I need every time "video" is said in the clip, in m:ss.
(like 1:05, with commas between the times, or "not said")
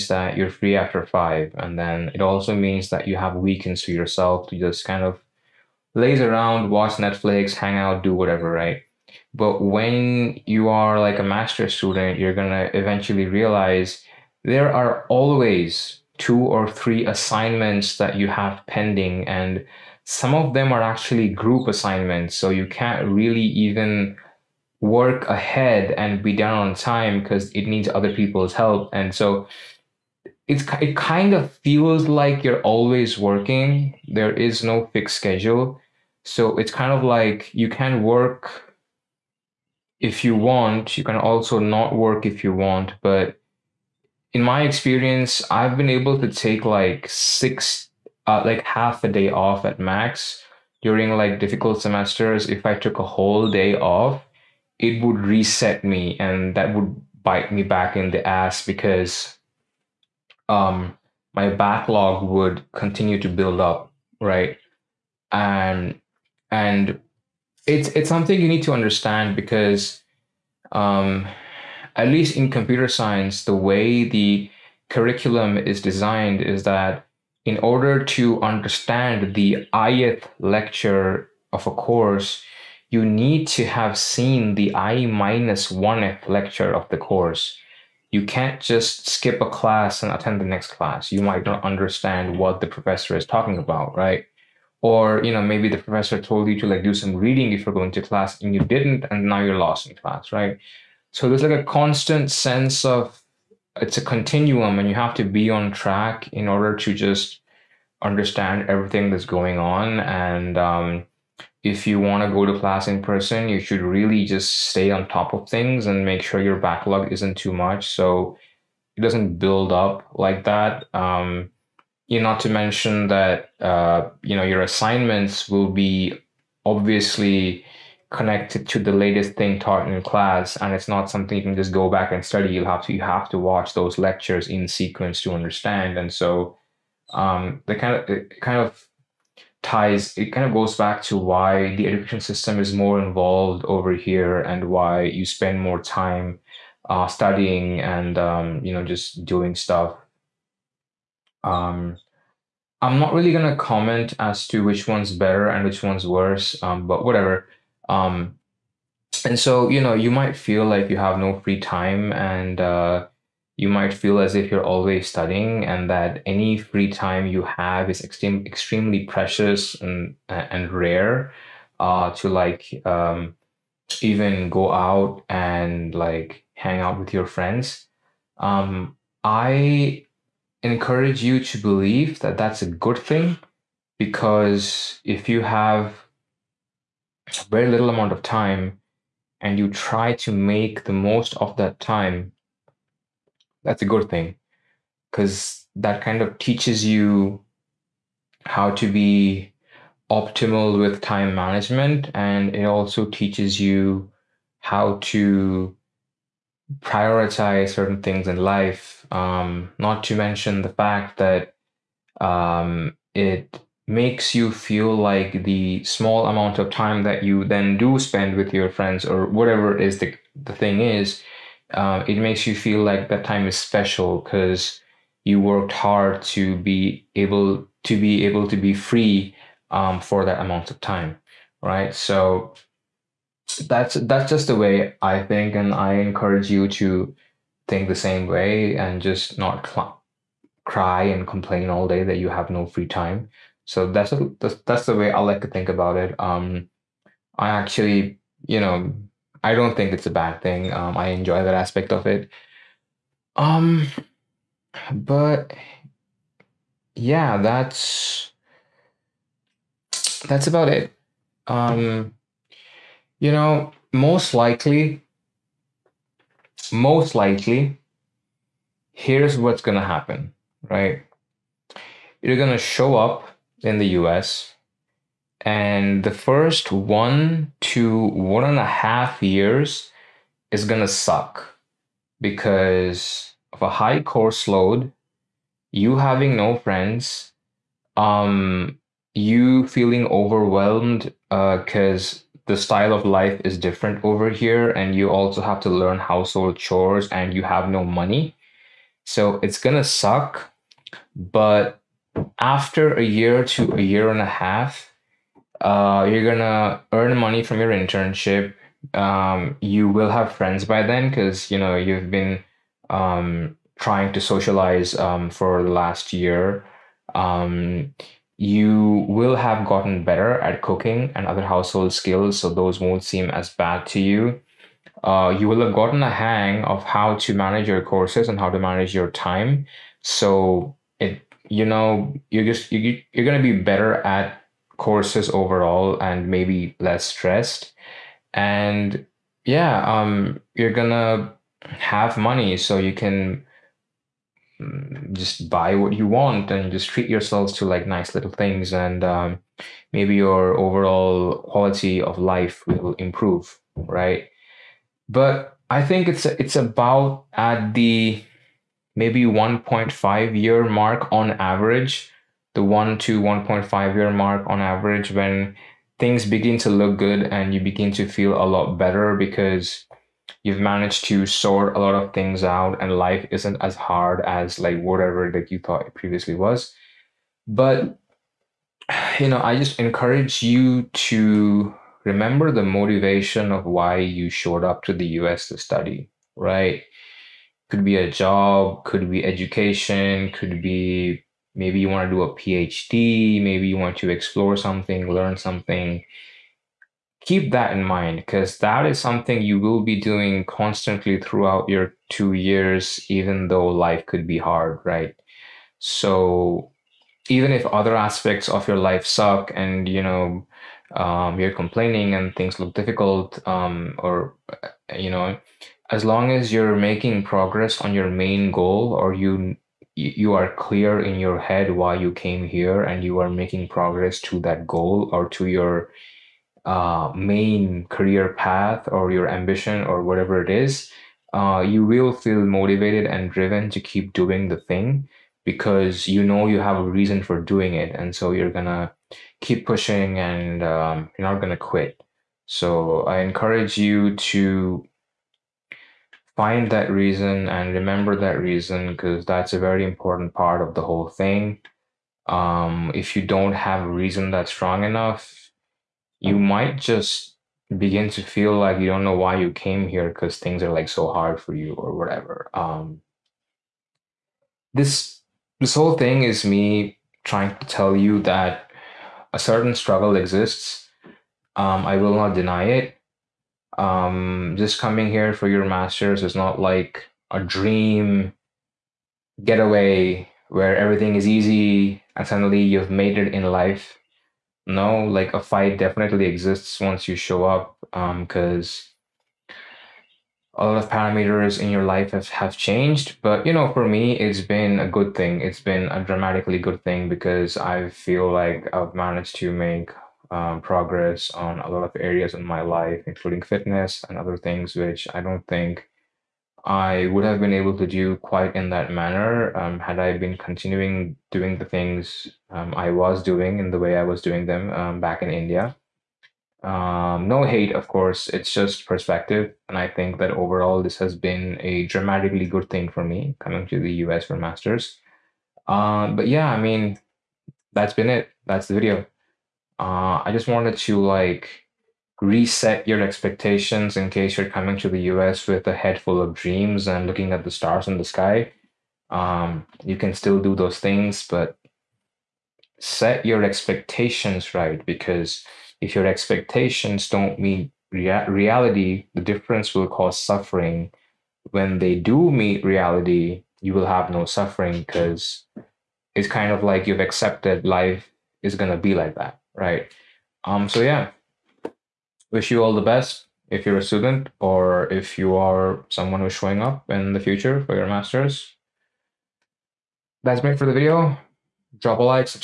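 8:48, 9:30.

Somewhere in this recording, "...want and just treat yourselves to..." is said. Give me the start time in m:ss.
5:46.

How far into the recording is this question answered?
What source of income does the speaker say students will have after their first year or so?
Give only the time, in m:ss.
5:07.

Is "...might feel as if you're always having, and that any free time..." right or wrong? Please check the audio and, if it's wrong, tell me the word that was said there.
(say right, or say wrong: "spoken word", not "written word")
wrong: "studying", not "having".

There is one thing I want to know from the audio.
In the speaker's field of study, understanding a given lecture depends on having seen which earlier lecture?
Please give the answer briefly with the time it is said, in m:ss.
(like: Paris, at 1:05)
i minus oneth, at 1:24.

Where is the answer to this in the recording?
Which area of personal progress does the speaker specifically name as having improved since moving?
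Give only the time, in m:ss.
8:23.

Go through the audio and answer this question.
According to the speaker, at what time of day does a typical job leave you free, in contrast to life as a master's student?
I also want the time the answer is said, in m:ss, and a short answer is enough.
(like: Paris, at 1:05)
after five, at 0:00.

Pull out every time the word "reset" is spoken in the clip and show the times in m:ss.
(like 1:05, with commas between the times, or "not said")
0:55, 8:52.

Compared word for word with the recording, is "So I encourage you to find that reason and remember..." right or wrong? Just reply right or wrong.
right.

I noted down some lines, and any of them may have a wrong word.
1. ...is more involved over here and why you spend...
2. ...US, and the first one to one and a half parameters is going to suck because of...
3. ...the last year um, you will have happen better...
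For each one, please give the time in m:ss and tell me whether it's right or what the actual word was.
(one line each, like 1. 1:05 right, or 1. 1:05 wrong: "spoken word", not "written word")
1. 2:22 right
2. 4:34 wrong: "years", not "parameters"
3. 5:15 wrong: "gotten", not "happen".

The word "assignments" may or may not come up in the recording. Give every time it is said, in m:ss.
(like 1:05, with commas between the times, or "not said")
0:17, 0:21, 2:04.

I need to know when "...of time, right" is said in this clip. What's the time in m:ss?
3:50.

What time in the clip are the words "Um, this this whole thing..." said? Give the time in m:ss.
7:42.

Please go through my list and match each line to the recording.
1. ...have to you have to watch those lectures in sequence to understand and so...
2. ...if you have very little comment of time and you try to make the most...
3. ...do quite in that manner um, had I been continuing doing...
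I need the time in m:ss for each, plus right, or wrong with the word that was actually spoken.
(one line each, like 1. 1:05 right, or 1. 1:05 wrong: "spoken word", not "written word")
1. 2:12 right
2. 3:05 wrong: "amount", not "comment"
3. 8:27 right.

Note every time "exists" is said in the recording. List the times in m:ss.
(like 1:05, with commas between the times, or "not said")
7:50, 8:06.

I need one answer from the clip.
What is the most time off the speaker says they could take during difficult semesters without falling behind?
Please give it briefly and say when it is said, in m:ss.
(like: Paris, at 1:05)
half a day, at 0:48.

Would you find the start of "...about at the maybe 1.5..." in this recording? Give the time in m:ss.
5:56.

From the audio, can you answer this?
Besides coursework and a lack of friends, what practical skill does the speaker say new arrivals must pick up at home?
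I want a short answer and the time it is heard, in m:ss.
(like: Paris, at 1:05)
household chores, at 4:55.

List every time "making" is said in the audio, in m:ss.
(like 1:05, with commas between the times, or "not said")
6:56, 7:03.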